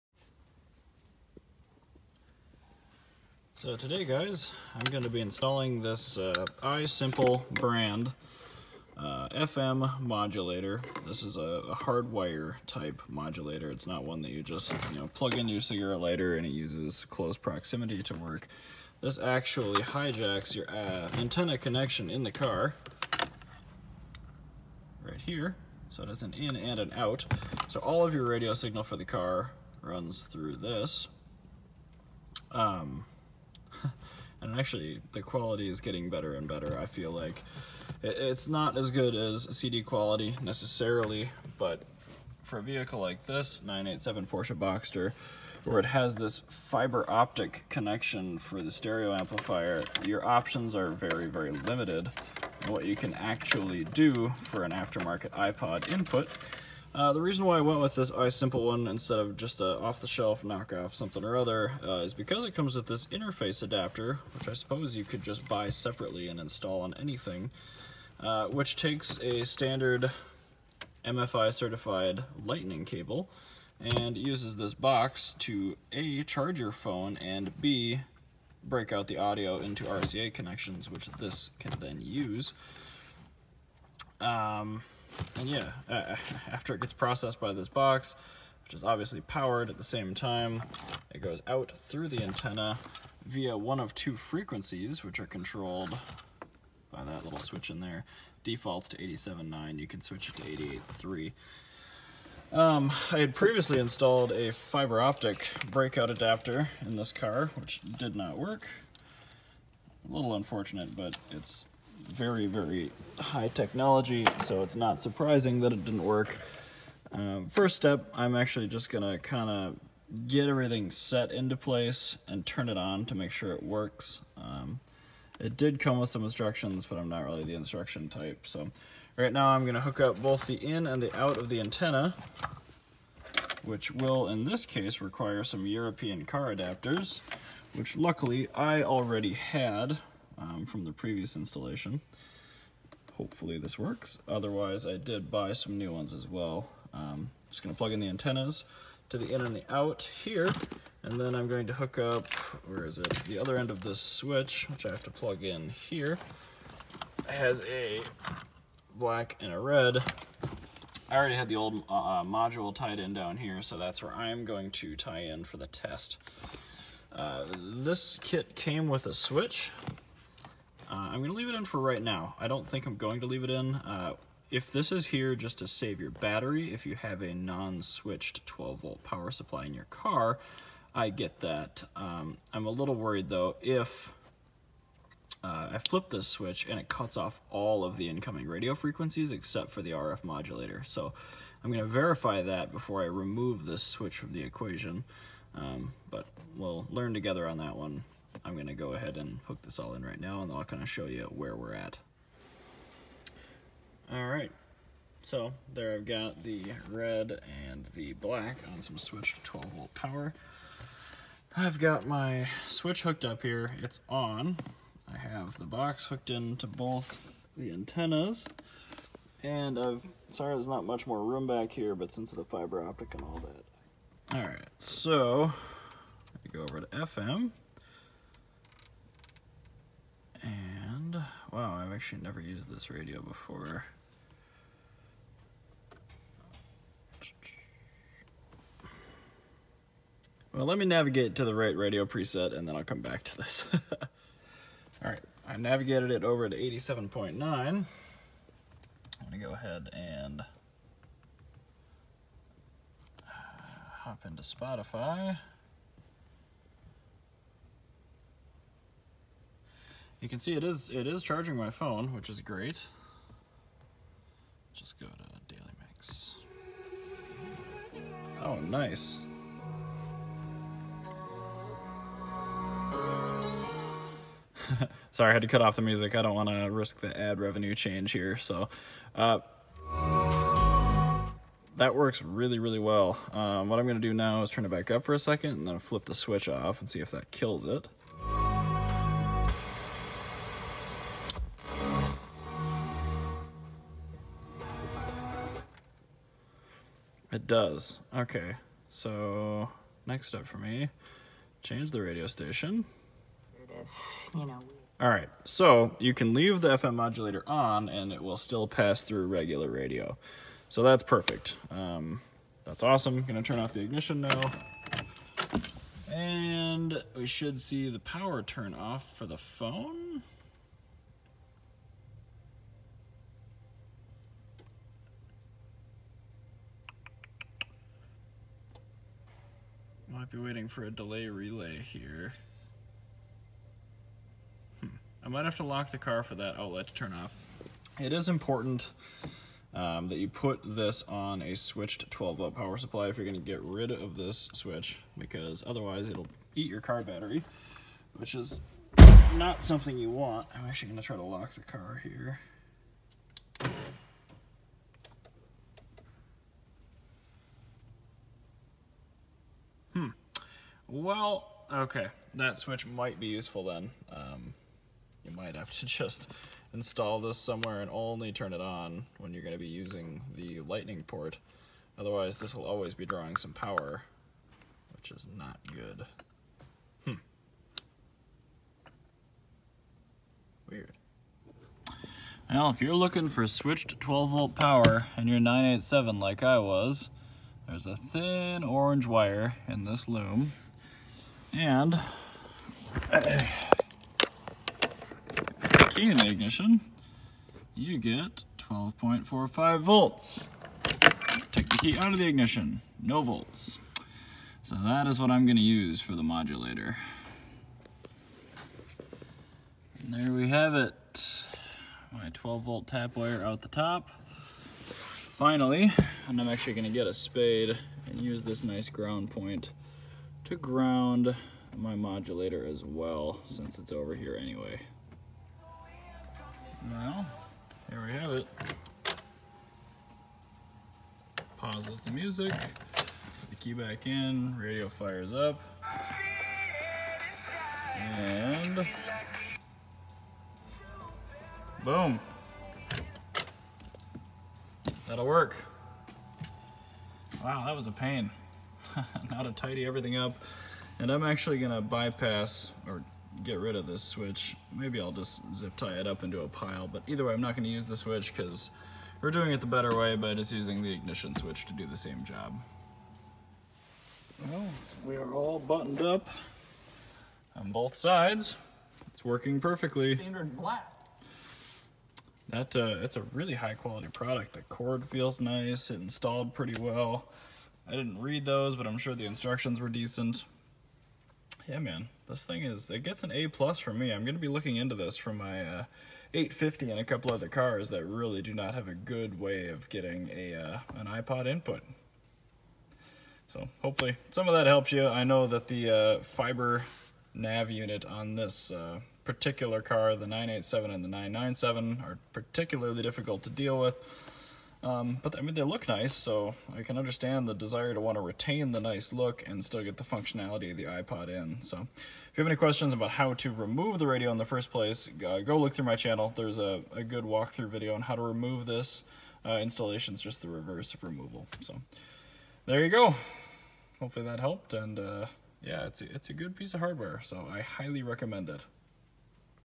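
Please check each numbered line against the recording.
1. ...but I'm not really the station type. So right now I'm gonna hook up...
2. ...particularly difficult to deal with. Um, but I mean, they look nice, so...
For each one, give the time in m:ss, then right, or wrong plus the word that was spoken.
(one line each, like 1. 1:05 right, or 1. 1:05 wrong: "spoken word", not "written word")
1. 2:06 wrong: "instruction", not "station"
2. 8:22 right.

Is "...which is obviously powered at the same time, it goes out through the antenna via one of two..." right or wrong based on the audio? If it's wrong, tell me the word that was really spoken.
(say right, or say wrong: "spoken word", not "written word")
right.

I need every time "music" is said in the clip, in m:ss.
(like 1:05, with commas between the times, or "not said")
4:35, 7:12.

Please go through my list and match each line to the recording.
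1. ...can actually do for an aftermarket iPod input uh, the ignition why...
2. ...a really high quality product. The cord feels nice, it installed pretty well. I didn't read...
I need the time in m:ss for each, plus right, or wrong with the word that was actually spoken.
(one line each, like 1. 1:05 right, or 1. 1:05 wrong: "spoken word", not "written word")
1. 0:52 wrong: "reason", not "ignition"
2. 7:53 right.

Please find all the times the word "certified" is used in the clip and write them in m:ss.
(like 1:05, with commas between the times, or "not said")
1:11.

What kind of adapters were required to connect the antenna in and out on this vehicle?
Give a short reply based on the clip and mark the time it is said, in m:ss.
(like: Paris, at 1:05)
European car adapters, at 2:15.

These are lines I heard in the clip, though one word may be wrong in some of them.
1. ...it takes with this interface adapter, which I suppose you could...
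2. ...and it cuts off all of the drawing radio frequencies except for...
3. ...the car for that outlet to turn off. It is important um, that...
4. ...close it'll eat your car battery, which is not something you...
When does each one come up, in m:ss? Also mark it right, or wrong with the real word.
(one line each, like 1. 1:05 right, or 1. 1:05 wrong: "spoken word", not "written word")
1. 1:02 wrong: "comes", not "takes"
2. 3:06 wrong: "incoming", not "drawing"
3. 5:35 right
4. 5:45 wrong: "otherwise", not "close".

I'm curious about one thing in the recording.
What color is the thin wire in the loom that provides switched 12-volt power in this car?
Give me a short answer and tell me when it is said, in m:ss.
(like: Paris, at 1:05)
Orange, at 6:28.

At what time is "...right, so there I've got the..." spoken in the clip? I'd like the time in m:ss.
3:24.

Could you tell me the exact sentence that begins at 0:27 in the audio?
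So all of your radio signal for the car runs through this.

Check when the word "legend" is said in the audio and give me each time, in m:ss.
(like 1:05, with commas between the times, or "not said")
not said.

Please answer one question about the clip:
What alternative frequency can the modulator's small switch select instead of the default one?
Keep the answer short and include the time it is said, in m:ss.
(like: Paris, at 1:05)
88.3, at 1:41.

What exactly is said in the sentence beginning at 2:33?
The other end of this switch, which I have to plug in here, has a black and a red.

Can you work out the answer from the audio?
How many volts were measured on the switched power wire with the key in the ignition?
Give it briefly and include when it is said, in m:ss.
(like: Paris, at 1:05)
12.45 volts, at 6:38.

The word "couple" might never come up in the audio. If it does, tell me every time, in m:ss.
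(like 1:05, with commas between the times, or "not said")
8:07.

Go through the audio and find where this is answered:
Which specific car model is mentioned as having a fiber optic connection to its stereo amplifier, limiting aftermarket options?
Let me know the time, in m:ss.
0:43.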